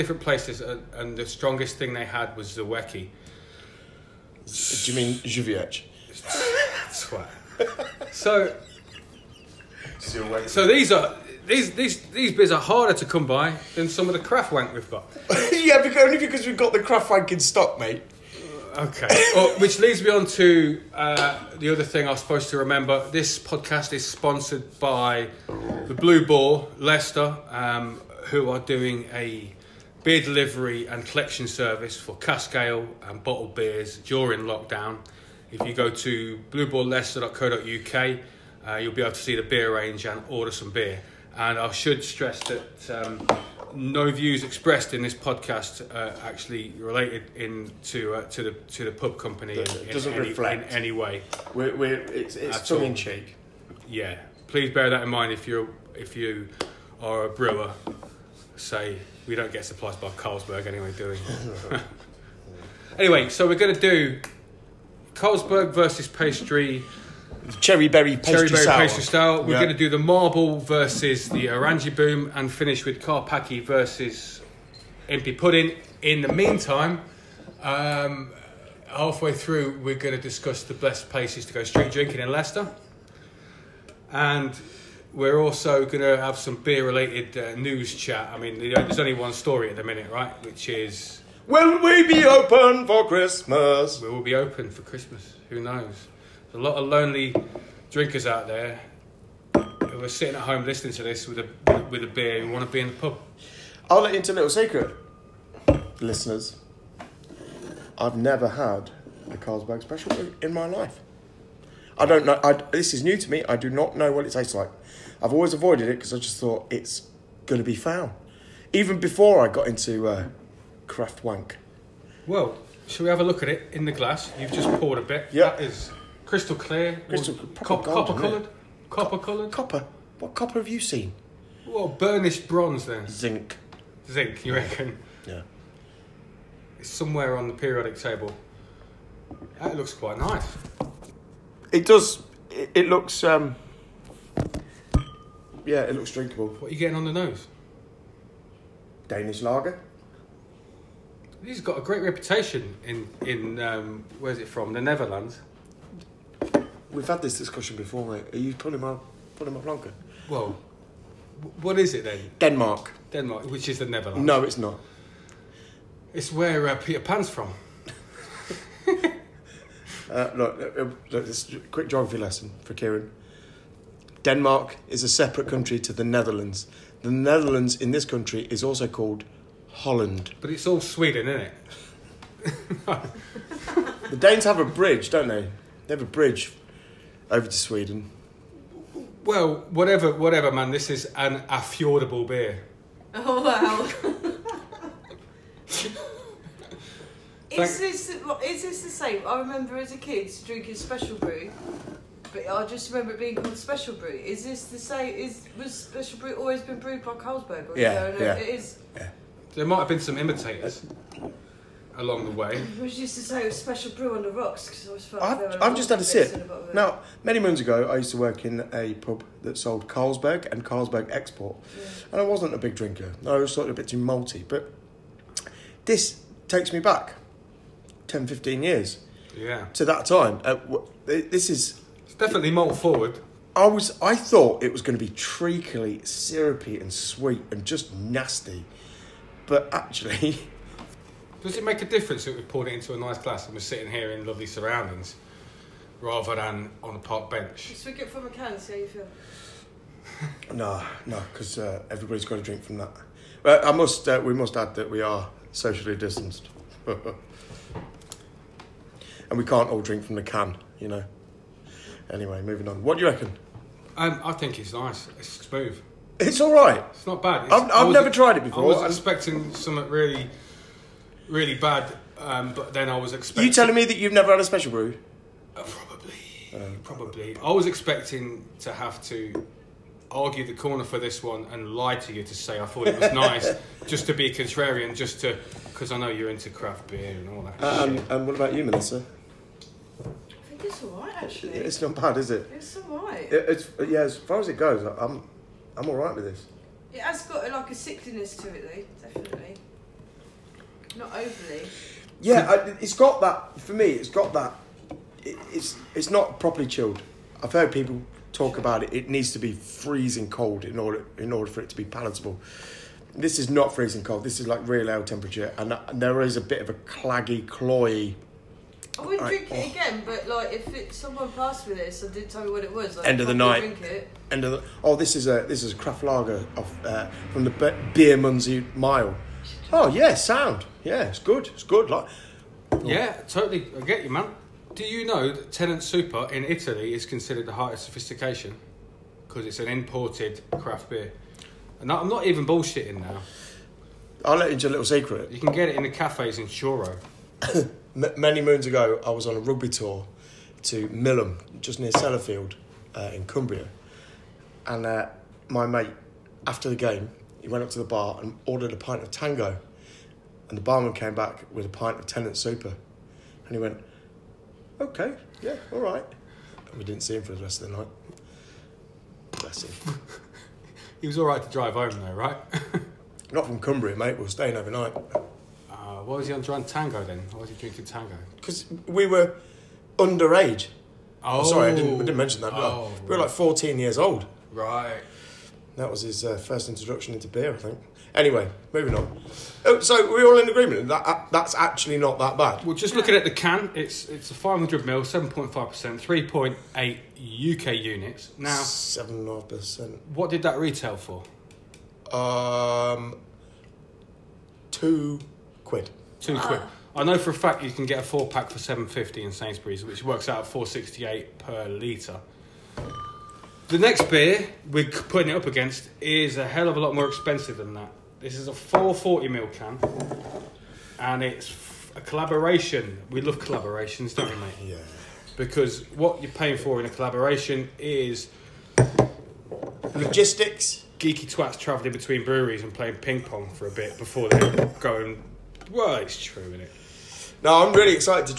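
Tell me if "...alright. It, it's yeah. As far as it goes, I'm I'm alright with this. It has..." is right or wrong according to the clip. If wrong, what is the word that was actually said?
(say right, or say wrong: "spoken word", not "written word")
right.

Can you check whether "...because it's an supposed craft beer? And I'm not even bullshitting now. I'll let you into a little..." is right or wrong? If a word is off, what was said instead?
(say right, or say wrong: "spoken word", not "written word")
wrong: "imported", not "supposed".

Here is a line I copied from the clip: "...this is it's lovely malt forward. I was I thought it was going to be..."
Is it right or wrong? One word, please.
wrong.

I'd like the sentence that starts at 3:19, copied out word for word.
I remember as a kid drinking special brew, but I just remember it being called special brew.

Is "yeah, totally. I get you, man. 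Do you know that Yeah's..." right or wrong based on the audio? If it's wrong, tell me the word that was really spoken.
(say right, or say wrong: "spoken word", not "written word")
wrong: "Tennent", not "Yeah".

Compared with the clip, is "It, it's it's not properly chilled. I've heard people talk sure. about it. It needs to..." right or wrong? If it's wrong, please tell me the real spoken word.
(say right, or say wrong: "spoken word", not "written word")
right.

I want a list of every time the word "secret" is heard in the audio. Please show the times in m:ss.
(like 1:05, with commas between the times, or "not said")
1:44, 5:44.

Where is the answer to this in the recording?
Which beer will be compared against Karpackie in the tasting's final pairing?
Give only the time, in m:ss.
1:15.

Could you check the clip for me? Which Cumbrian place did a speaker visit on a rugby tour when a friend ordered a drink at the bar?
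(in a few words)
Millom.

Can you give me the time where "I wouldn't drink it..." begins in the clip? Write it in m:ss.
5:18.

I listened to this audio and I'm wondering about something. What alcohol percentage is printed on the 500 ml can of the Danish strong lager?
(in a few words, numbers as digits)
7.5%.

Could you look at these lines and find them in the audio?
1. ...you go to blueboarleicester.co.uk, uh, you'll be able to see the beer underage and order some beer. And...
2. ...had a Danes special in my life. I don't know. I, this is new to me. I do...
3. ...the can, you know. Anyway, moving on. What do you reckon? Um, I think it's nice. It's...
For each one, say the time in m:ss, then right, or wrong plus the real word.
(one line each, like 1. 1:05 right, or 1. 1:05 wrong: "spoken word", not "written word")
1. 0:35 wrong: "range", not "underage"
2. 1:48 wrong: "Carlsberg", not "Danes"
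3. 4:20 right.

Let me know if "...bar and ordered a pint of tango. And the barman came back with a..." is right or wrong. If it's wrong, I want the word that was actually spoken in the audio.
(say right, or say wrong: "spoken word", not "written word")
right.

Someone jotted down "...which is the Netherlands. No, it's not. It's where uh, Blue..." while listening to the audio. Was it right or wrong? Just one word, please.
wrong.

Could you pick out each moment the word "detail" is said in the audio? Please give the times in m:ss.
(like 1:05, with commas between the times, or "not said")
not said.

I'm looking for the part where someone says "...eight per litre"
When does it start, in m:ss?
6:51.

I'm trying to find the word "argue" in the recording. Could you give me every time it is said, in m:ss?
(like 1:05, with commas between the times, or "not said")
4:40.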